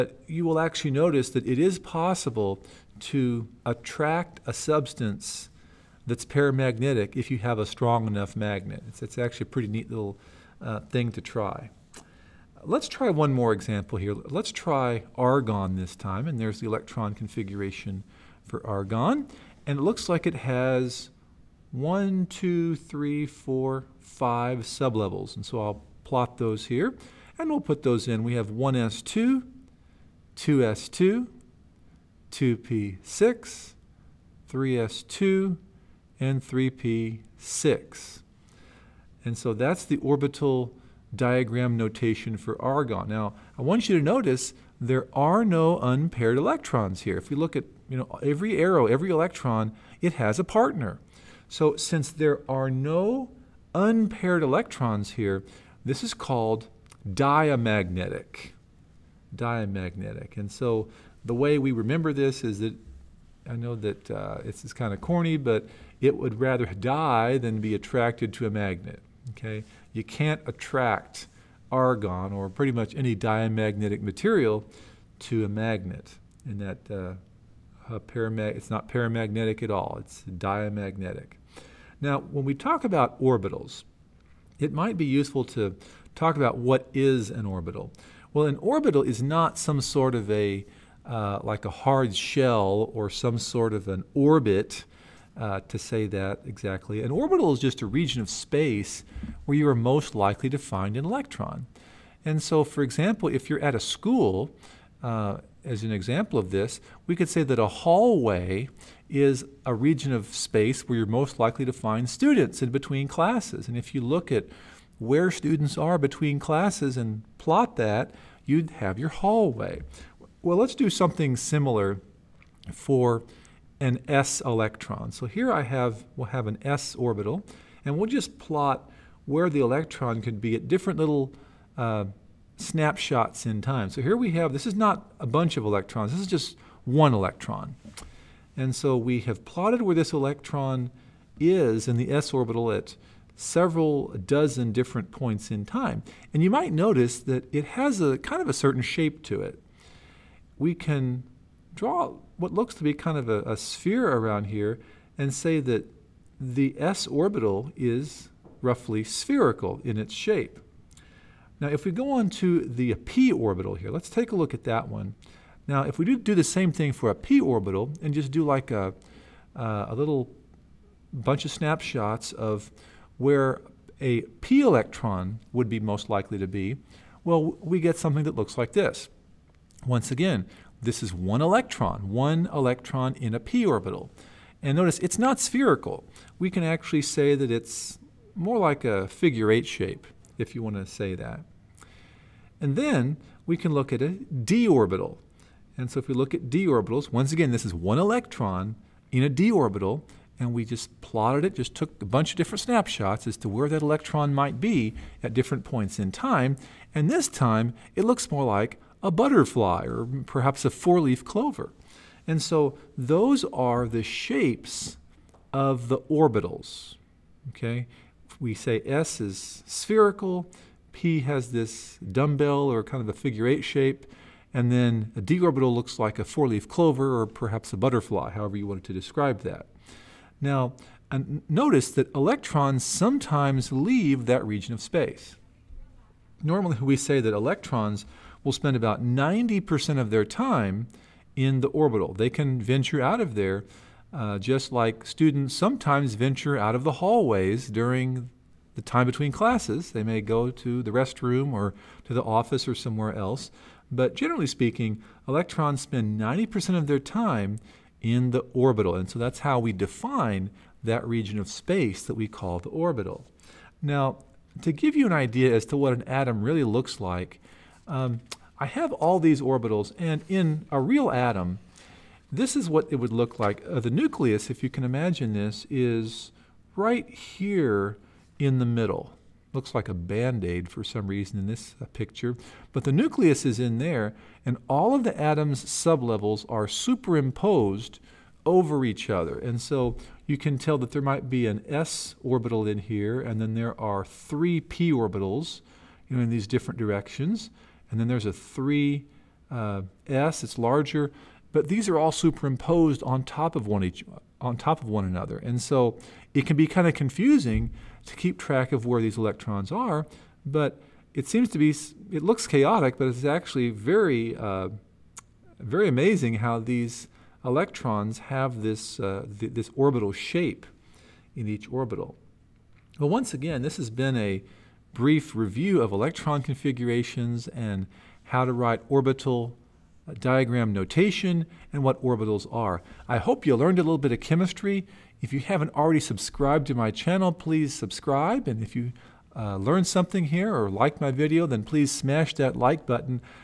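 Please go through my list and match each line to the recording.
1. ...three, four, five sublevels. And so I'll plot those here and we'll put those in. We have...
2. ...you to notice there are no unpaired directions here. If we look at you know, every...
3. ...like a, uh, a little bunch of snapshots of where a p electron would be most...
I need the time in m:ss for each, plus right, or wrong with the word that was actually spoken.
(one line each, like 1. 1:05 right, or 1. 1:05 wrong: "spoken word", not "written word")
1. 0:22 right
2. 0:43 wrong: "electrons", not "directions"
3. 2:48 right.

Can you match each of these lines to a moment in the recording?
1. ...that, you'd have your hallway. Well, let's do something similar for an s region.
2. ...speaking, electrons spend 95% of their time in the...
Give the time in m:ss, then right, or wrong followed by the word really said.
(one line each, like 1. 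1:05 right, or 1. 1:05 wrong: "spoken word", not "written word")
1. 1:57 wrong: "electron", not "region"
2. 4:14 wrong: "90", not "95".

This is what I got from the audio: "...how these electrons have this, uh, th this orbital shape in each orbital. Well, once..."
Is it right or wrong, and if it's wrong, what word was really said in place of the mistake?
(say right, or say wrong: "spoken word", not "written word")
right.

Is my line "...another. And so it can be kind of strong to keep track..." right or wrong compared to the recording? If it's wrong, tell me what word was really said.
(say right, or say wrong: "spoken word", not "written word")
wrong: "confusing", not "strong".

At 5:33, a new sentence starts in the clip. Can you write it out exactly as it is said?
I hope you learned a little bit of chemistry.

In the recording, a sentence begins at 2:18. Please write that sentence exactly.
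And so we have plotted where this electron is in the s orbital at several dozen different points in time.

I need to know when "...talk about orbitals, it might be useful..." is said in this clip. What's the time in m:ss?
1:22.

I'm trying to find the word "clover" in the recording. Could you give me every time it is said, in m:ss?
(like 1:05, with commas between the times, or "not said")
3:31, 3:46.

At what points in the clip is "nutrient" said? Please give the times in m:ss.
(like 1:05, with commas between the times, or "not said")
not said.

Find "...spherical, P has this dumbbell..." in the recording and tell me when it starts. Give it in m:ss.
3:39.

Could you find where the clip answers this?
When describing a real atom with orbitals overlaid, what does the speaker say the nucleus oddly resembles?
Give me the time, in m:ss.
4:39.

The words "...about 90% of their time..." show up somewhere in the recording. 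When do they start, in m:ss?
3:58.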